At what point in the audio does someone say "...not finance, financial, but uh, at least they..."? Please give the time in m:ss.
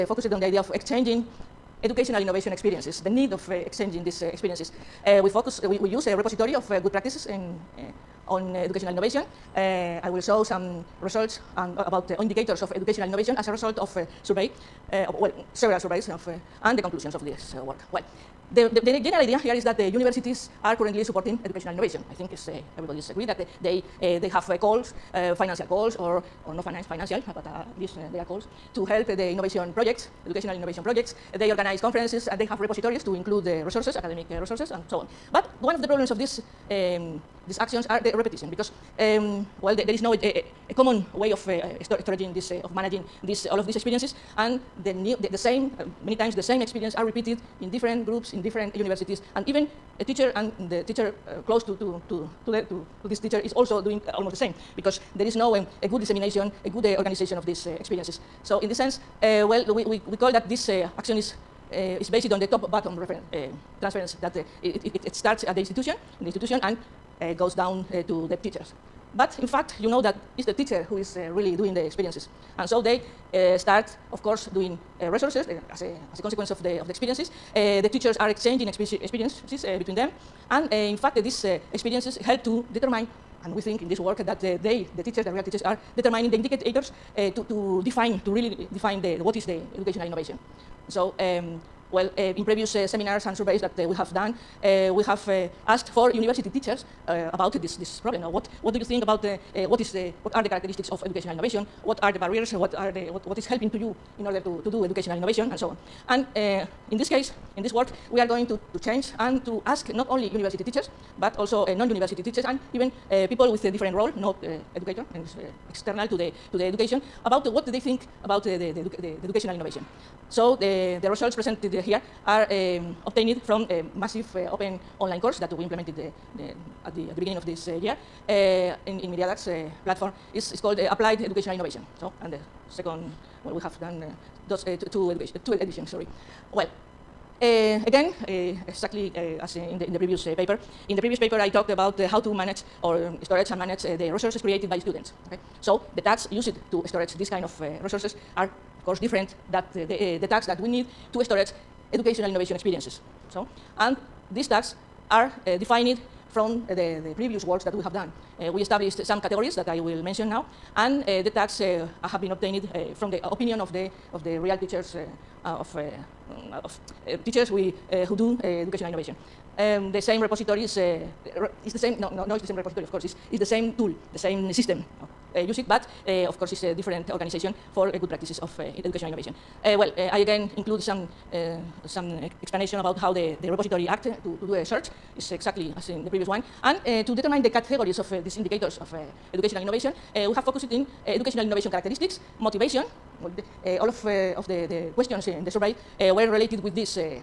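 0:26.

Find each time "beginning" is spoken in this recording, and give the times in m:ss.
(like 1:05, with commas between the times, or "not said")
2:07.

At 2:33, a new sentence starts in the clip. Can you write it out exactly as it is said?
So, and these tags are uh, defined from uh, the, the, previous works that we have done.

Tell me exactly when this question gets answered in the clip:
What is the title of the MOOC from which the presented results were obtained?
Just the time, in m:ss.
2:10.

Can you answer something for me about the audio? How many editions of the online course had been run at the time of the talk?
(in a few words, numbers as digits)
2.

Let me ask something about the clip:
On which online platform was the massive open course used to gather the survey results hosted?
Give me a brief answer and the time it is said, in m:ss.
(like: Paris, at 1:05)
Miriadax, at 2:09.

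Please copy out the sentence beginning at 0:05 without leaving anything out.
Uh, we focus, uh, we, we use a repository of uh, good practices in, uh, on educational innovation.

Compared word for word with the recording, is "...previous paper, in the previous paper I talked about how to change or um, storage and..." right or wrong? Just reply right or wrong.
wrong.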